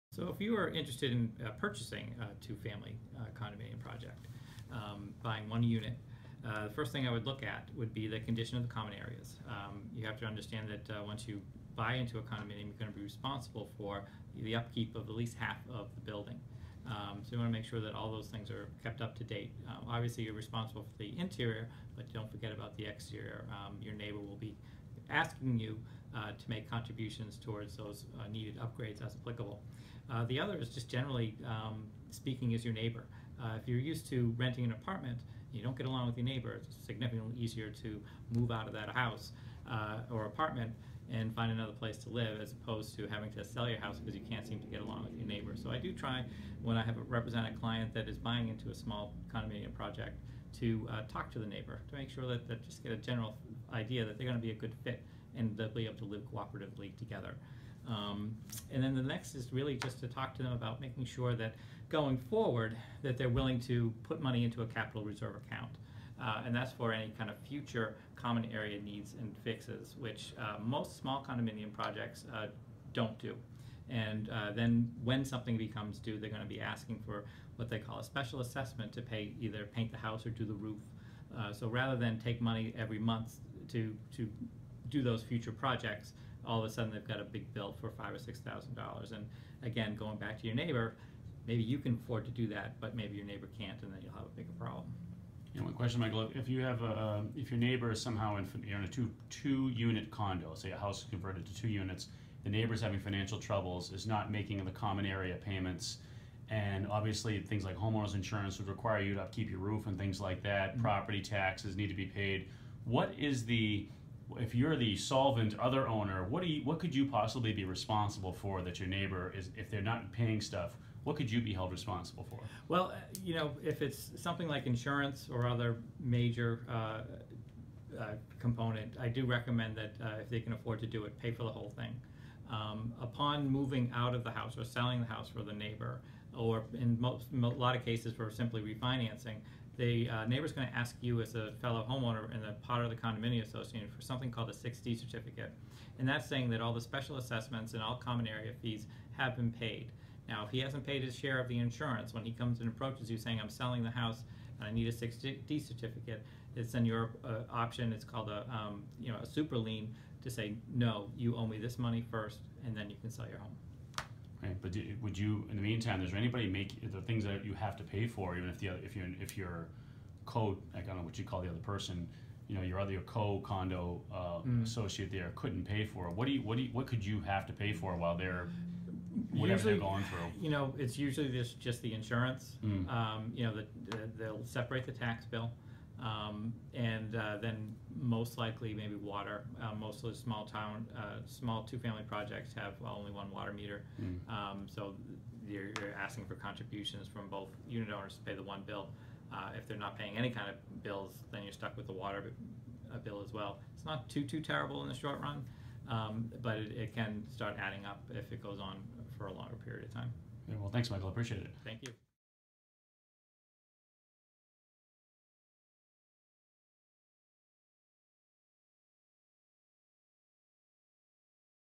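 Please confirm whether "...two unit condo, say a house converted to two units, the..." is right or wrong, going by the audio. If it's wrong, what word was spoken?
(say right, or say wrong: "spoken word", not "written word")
right.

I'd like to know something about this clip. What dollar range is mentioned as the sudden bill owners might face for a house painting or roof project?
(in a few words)
$5,000-$6,000.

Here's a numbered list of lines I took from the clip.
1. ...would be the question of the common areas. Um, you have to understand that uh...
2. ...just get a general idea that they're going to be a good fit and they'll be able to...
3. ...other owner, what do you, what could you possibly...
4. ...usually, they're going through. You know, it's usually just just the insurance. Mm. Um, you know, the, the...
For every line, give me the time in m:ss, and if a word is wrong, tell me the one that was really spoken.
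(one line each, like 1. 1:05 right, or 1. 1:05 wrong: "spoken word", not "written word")
1. 0:07 wrong: "condition", not "question"
2. 0:52 right
3. 1:55 right
4. 2:59 right.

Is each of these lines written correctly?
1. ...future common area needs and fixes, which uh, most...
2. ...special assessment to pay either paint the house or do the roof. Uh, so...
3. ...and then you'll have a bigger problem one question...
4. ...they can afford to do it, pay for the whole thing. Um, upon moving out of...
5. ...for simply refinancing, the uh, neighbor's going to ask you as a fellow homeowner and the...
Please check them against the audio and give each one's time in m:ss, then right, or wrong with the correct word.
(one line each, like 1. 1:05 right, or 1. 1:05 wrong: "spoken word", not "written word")
1. 1:07 right
2. 1:18 right
3. 1:33 right
4. 2:10 right
5. 2:18 right.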